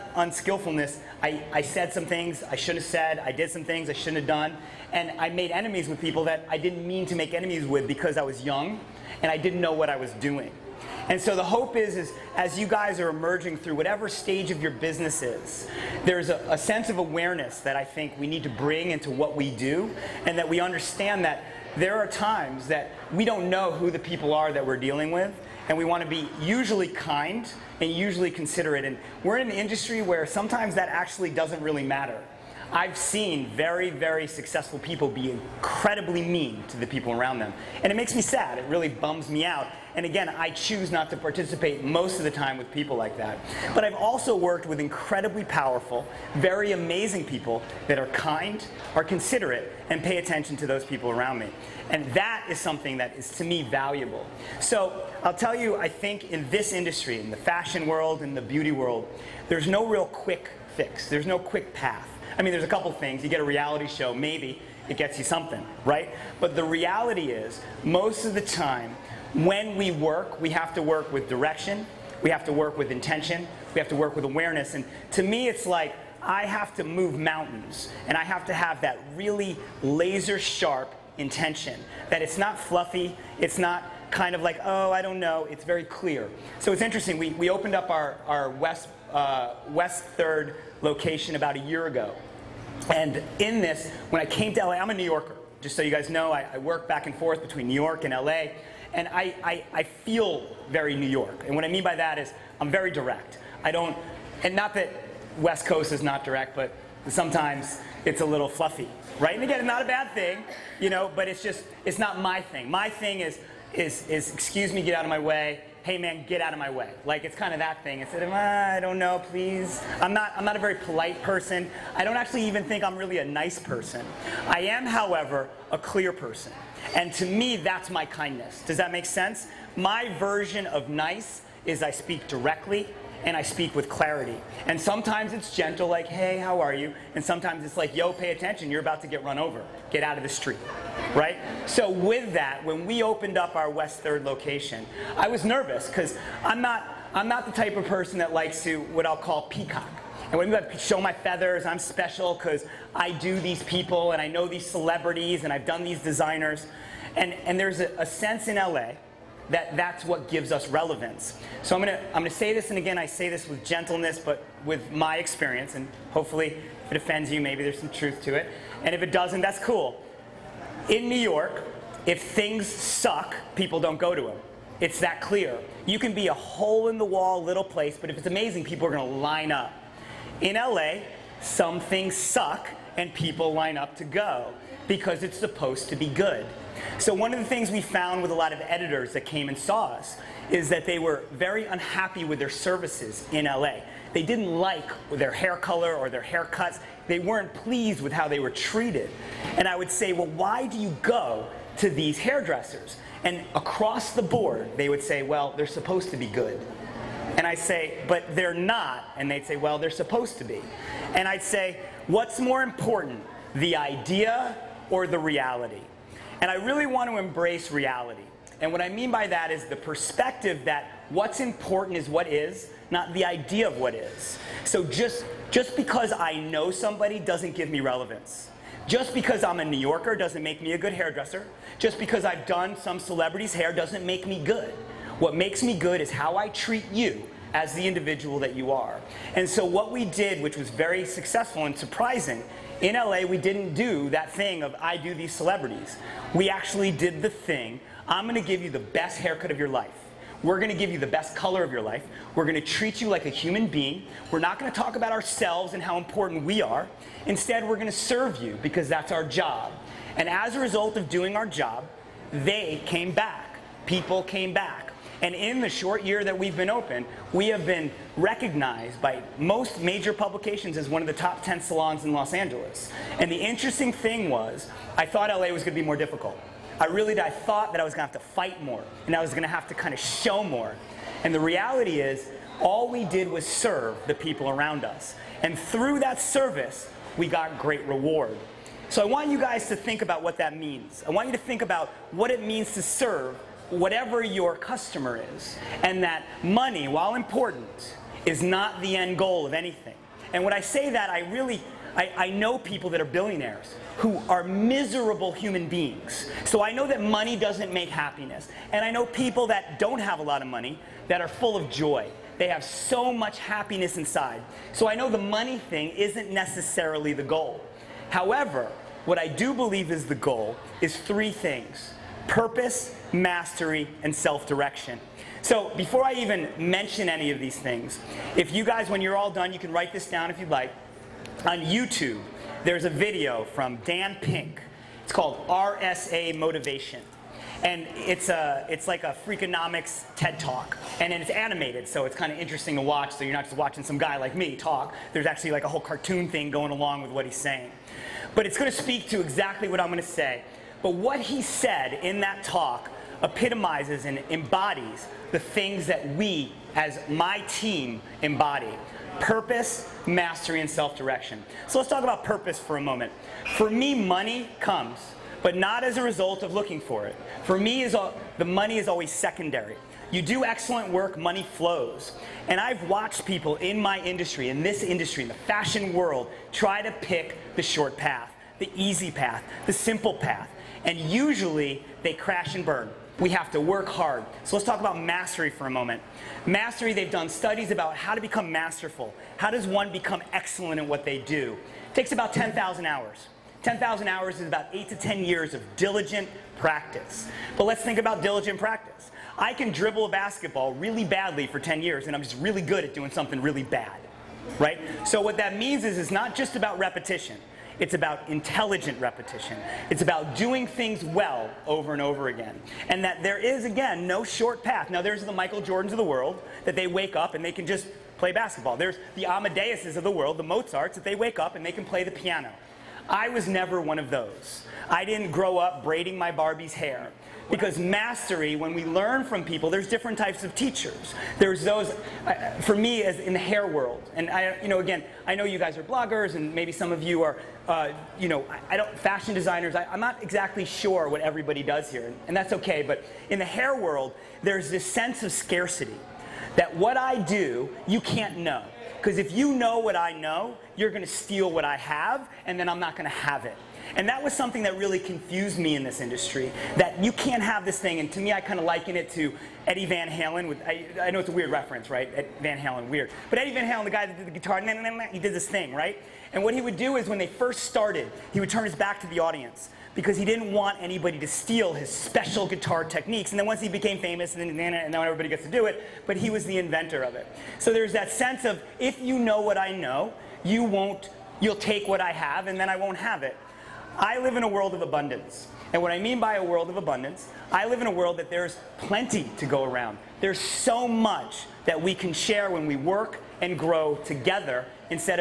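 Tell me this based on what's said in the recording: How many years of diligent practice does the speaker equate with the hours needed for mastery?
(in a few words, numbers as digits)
8 to 10.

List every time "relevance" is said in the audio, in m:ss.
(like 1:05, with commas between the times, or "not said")
2:40, 3:47.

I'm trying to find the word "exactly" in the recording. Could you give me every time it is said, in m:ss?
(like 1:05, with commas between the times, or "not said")
5:49, 7:20.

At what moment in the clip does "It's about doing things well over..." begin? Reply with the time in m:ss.
6:49.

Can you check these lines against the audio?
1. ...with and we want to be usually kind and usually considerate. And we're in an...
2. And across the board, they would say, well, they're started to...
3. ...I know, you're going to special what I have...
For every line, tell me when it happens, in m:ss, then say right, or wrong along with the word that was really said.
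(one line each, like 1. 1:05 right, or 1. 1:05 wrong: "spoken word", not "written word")
1. 0:25 right
2. 3:23 wrong: "supposed", not "started"
3. 7:29 wrong: "steal", not "special".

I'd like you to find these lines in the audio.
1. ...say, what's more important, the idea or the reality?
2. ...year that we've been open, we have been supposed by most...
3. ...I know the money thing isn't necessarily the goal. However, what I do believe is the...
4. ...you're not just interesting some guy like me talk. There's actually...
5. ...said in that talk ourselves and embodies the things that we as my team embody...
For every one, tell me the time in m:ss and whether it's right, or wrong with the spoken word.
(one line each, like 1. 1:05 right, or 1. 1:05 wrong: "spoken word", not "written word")
1. 3:31 right
2. 4:26 wrong: "recognized", not "supposed"
3. 5:14 right
4. 5:43 wrong: "watching", not "interesting"
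5. 5:51 wrong: "epitomizes", not "ourselves".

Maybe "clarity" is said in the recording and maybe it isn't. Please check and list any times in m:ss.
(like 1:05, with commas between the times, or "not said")
2:13.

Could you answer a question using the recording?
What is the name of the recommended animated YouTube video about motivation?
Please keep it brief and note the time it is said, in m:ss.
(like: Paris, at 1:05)
RSA Motivation, at 5:35.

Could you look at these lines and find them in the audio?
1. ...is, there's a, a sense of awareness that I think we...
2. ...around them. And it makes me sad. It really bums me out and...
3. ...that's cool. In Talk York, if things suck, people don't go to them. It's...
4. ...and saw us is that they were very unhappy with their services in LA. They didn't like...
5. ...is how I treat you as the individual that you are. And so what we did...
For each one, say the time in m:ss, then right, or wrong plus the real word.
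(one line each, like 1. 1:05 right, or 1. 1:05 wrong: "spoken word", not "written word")
1. 0:15 right
2. 0:37 right
3. 2:49 wrong: "New", not "Talk"
4. 3:09 right
5. 3:56 right.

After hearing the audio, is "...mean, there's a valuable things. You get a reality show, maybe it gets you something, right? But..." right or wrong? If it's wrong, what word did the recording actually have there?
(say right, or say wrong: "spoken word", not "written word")
wrong: "couple", not "valuable".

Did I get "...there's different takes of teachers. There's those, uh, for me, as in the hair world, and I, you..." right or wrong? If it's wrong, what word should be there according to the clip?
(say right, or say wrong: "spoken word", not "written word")
wrong: "types", not "takes".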